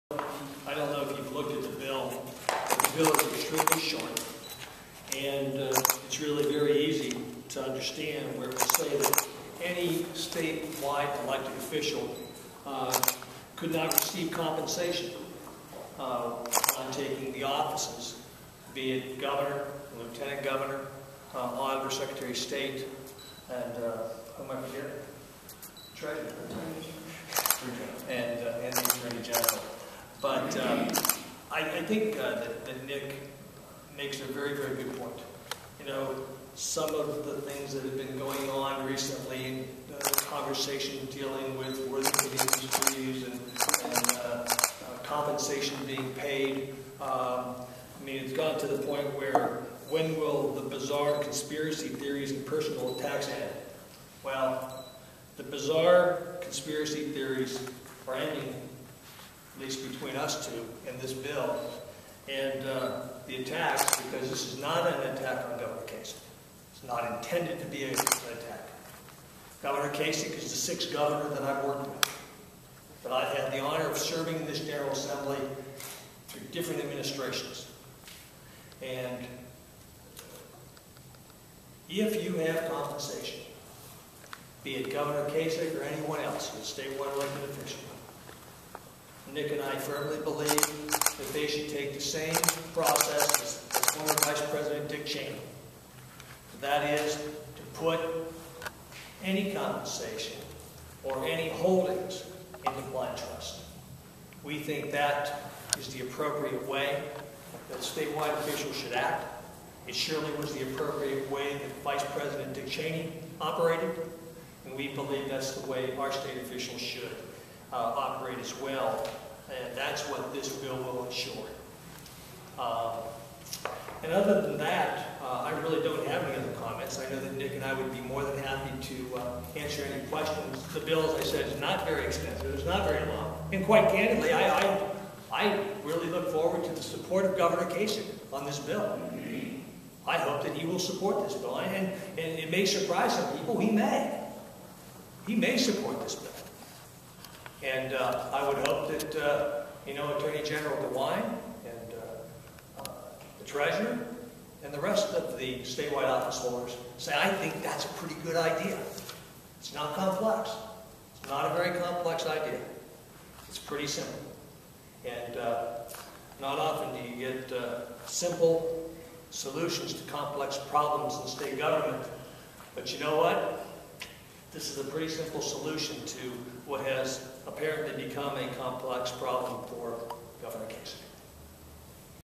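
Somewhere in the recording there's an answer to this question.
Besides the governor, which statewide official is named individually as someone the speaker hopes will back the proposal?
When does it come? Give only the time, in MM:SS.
02:30.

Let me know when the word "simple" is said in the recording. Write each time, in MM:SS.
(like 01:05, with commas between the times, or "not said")
02:43, 02:48, 02:55.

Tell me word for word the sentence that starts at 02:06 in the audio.
I know that Nick and I would be more than happy to uh, answer any questions.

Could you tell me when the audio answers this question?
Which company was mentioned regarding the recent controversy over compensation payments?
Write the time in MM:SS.
00:41.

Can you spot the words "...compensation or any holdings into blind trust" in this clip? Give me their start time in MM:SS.
01:39.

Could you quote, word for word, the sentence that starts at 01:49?
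It surely was the appropriate way that Vice President Dick Cheney operated, and we believe that's the way our state officials should.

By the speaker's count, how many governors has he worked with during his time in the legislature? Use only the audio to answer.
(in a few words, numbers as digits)
6.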